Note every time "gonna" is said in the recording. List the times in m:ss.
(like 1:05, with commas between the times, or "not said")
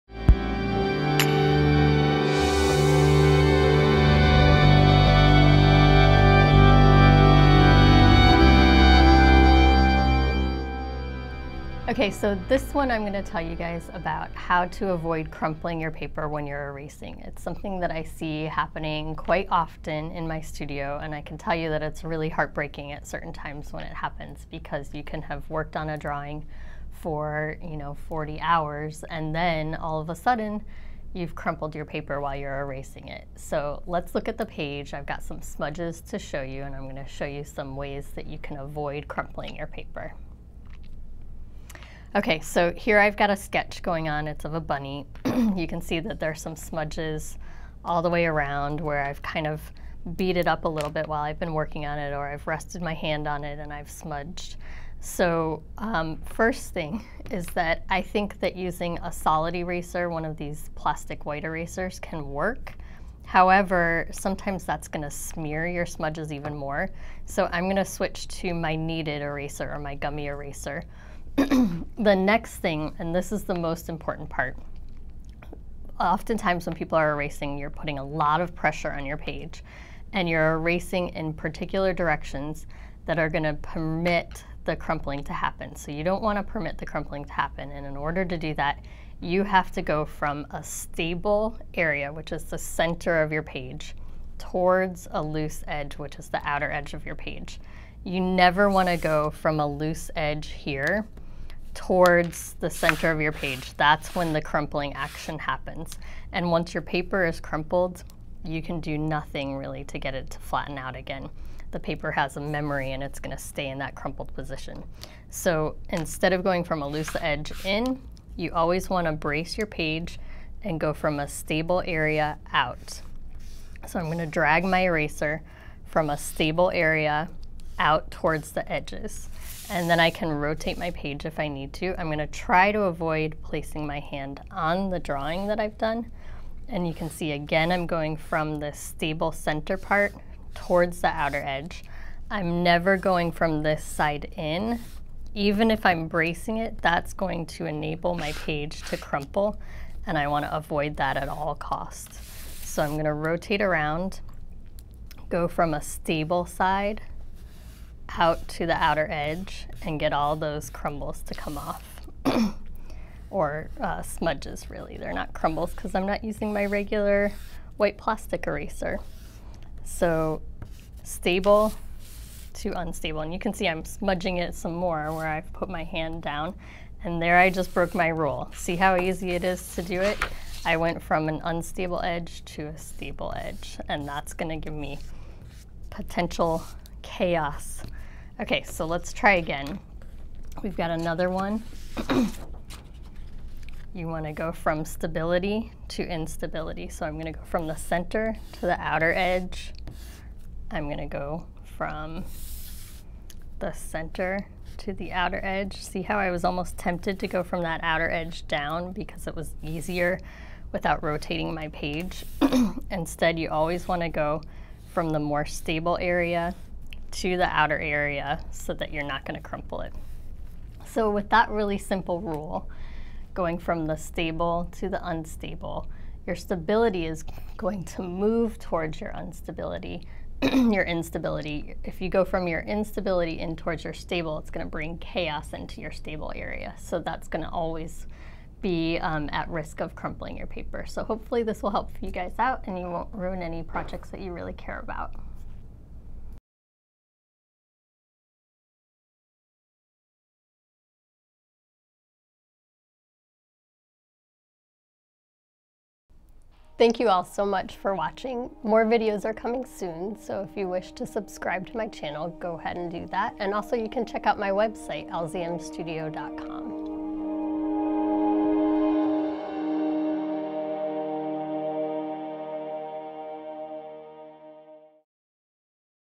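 2:12, 2:32, 3:04.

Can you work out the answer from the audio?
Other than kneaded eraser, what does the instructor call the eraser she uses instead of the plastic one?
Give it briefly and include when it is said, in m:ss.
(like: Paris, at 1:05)
Gummy eraser, at 1:09.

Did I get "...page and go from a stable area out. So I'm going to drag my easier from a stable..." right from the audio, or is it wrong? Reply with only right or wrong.
wrong.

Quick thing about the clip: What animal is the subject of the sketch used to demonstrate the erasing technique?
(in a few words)
Bunny.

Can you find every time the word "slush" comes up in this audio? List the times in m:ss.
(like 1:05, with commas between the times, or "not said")
not said.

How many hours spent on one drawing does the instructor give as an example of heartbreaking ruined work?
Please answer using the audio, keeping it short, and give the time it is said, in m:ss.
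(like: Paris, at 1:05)
40, at 0:28.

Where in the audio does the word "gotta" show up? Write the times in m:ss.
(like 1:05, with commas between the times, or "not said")
not said.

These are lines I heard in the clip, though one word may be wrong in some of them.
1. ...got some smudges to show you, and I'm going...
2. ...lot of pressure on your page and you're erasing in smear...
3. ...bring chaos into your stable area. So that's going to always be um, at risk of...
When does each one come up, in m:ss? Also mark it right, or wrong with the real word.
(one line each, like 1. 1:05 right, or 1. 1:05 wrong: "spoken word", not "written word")
1. 0:35 right
2. 1:18 wrong: "particular", not "smear"
3. 3:54 right.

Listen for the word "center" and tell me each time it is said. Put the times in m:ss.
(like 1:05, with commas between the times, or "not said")
1:32, 1:42, 2:19, 3:17, 3:23.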